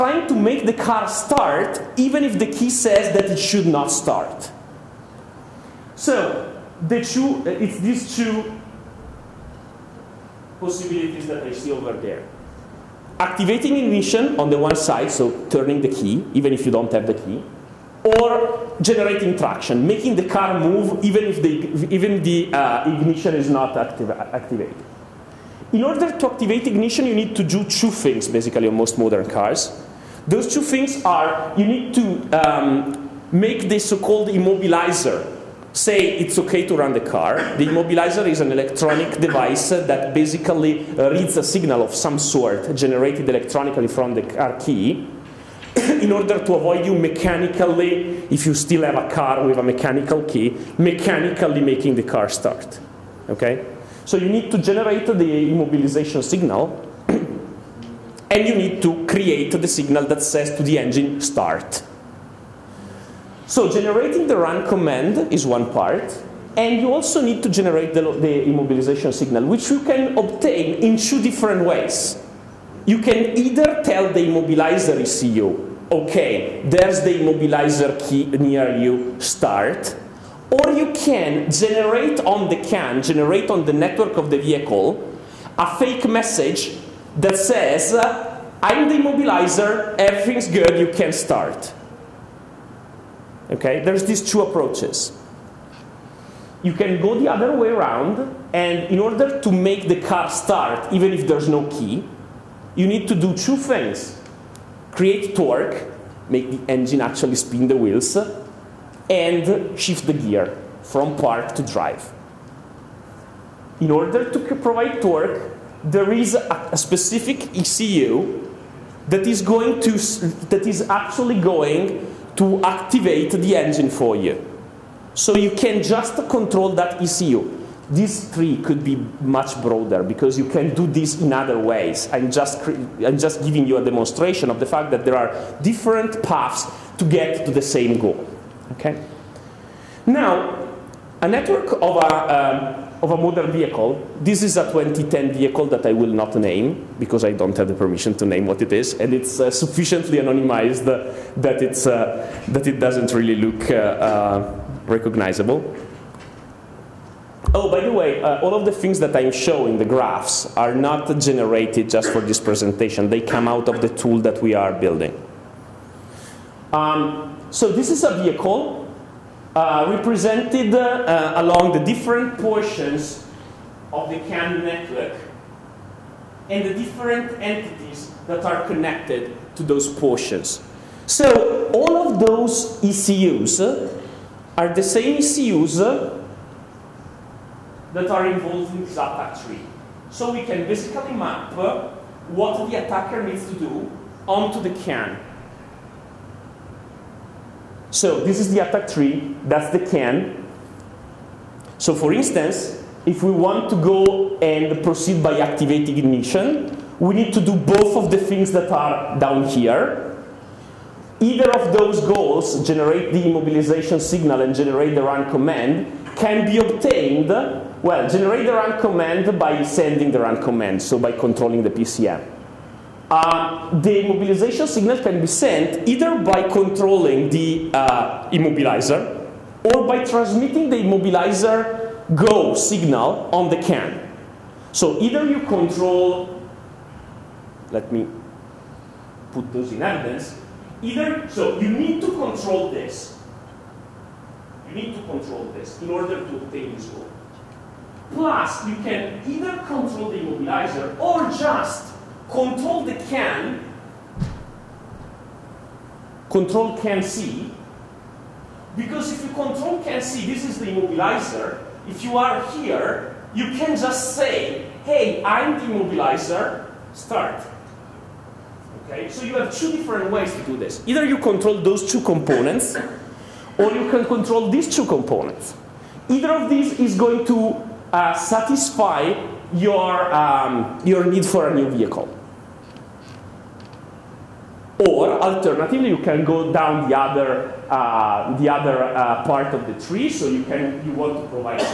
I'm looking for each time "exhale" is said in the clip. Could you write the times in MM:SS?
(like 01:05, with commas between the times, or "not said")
not said.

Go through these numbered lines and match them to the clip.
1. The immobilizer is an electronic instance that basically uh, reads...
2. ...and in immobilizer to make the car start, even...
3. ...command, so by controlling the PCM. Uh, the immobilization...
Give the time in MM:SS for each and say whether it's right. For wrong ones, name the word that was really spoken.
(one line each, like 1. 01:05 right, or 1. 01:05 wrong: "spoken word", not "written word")
1. 00:37 wrong: "device", not "instance"
2. 01:38 wrong: "order", not "immobilizer"
3. 03:40 right.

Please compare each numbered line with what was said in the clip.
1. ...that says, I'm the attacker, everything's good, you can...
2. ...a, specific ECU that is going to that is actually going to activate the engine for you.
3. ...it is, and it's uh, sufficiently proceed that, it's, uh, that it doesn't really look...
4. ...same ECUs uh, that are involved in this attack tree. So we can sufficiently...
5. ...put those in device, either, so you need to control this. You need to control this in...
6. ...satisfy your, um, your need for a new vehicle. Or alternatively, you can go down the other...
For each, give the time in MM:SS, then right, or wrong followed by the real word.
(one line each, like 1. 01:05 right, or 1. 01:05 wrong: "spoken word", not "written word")
1. 01:27 wrong: "immobilizer", not "attacker"
2. 01:56 right
3. 02:28 wrong: "anonymized", not "proceed"
4. 03:04 wrong: "basically", not "sufficiently"
5. 03:59 wrong: "evidence", not "device"
6. 04:38 right.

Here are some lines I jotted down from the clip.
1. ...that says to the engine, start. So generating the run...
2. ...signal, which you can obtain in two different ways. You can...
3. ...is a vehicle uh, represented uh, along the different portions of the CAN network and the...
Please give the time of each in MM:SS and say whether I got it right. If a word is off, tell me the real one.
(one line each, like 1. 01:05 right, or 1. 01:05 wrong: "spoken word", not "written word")
1. 01:00 right
2. 01:09 right
3. 02:47 right.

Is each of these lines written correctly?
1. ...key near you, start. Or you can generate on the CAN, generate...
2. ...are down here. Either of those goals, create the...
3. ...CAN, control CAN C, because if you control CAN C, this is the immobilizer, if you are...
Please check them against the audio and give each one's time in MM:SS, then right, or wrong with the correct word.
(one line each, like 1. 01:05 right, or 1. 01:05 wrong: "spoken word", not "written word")
1. 01:18 right
2. 03:28 wrong: "generate", not "create"
3. 04:13 right.